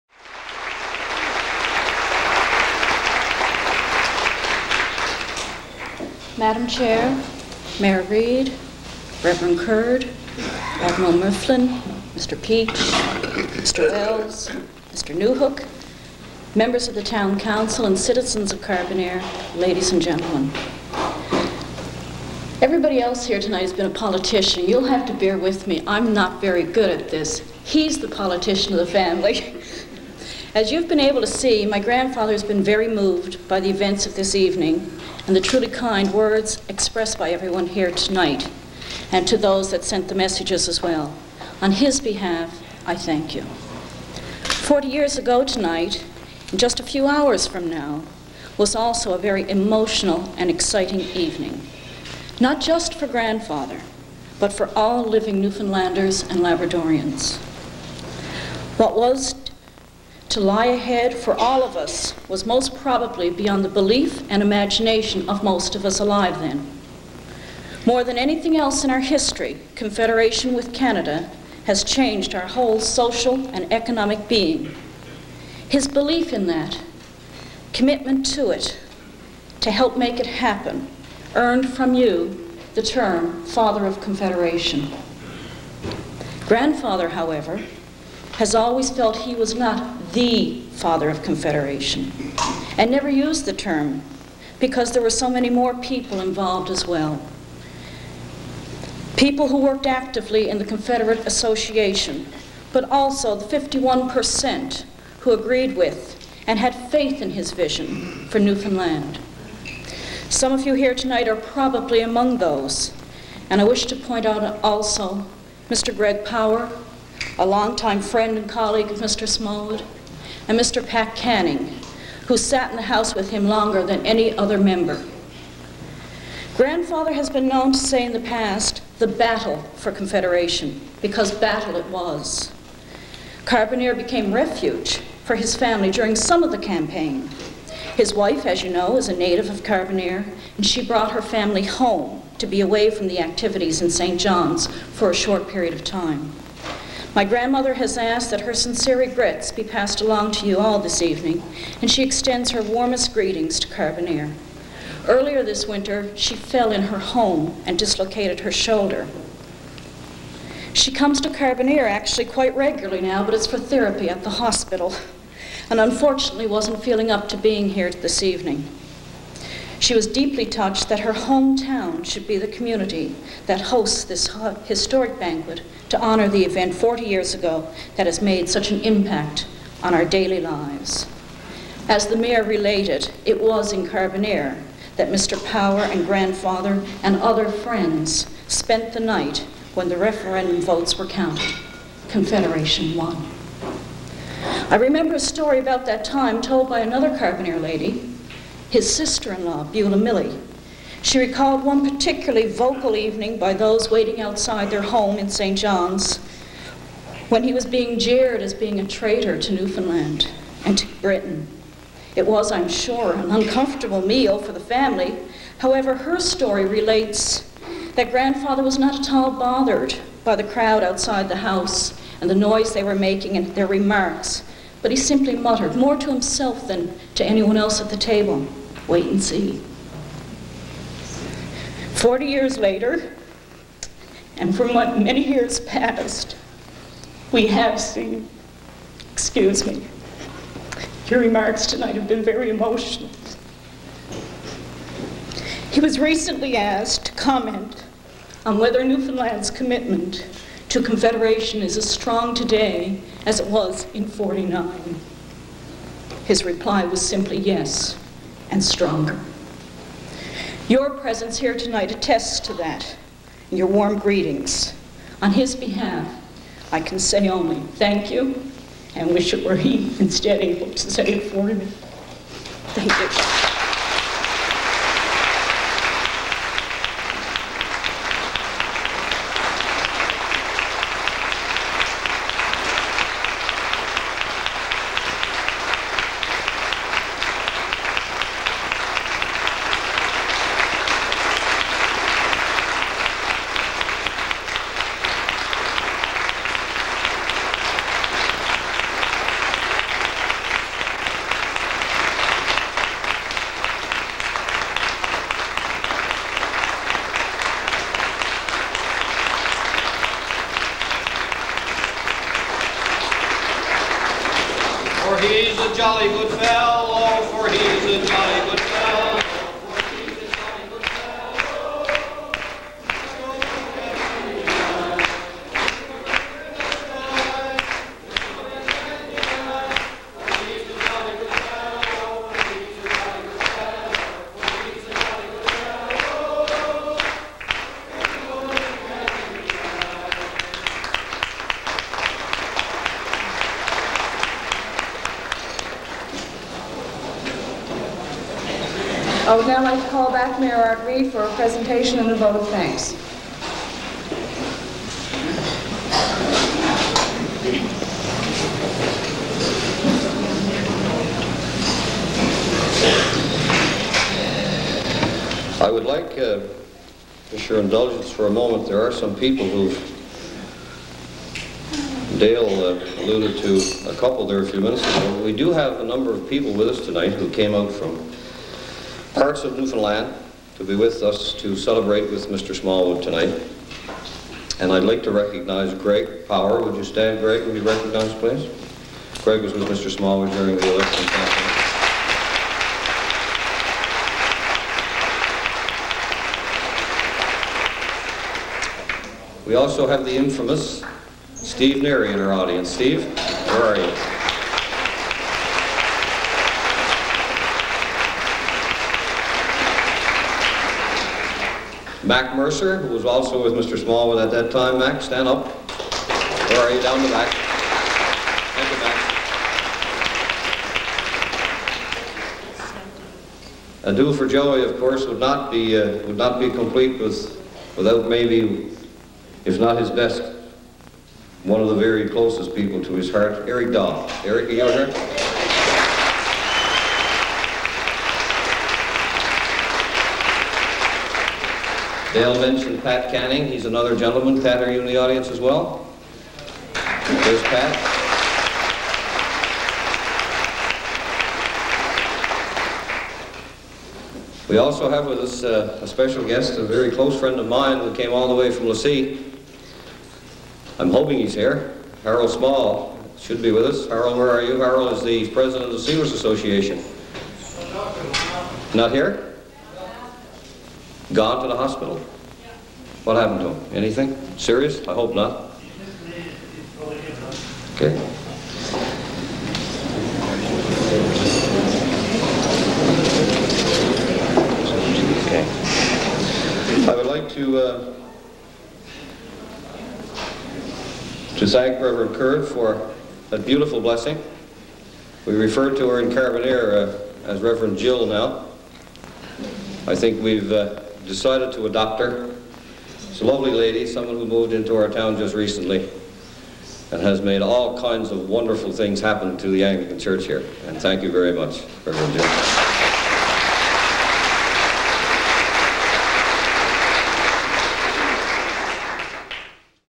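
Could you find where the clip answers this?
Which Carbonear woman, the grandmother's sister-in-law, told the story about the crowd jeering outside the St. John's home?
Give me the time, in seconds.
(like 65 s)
199 s.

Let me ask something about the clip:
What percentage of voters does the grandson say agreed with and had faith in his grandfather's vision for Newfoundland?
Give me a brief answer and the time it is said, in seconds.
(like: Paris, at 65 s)
51%, at 103 s.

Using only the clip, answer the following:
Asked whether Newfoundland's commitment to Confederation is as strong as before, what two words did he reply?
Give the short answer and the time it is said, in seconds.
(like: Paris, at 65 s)
yes and stronger, at 257 s.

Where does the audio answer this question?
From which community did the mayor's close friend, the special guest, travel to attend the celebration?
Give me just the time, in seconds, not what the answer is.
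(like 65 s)
458 s.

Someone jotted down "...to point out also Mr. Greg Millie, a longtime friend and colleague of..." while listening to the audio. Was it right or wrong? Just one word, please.
wrong.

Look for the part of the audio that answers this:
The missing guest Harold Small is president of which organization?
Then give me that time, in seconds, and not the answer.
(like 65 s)
465 s.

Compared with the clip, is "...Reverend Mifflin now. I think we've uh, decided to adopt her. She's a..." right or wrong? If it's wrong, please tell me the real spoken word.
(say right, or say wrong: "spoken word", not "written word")
wrong: "Jill", not "Mifflin".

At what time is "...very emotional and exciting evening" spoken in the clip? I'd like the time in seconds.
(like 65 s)
49 s.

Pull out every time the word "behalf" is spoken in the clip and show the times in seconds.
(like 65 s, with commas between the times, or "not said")
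42 s, 265 s.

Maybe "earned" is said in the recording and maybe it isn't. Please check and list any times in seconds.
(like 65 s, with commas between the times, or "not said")
81 s.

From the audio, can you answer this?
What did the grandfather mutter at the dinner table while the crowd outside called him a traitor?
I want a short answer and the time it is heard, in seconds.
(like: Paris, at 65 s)
wait and see, at 228 s.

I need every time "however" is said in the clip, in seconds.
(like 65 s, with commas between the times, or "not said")
87 s, 215 s.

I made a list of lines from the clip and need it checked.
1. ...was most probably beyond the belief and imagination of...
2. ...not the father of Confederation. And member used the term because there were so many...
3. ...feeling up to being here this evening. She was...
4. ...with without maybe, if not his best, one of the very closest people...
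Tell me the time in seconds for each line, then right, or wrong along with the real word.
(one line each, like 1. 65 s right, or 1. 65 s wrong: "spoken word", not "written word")
1. 62 s right
2. 89 s wrong: "never", not "member"
3. 166 s right
4. 426 s right.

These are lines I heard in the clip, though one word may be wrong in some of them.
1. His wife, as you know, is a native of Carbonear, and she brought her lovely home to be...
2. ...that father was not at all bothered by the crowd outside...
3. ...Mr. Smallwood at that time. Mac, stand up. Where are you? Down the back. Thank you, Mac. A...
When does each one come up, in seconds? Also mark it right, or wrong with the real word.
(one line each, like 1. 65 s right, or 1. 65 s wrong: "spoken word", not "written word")
1. 137 s wrong: "family", not "lovely"
2. 217 s wrong: "grandfather", not "father"
3. 413 s right.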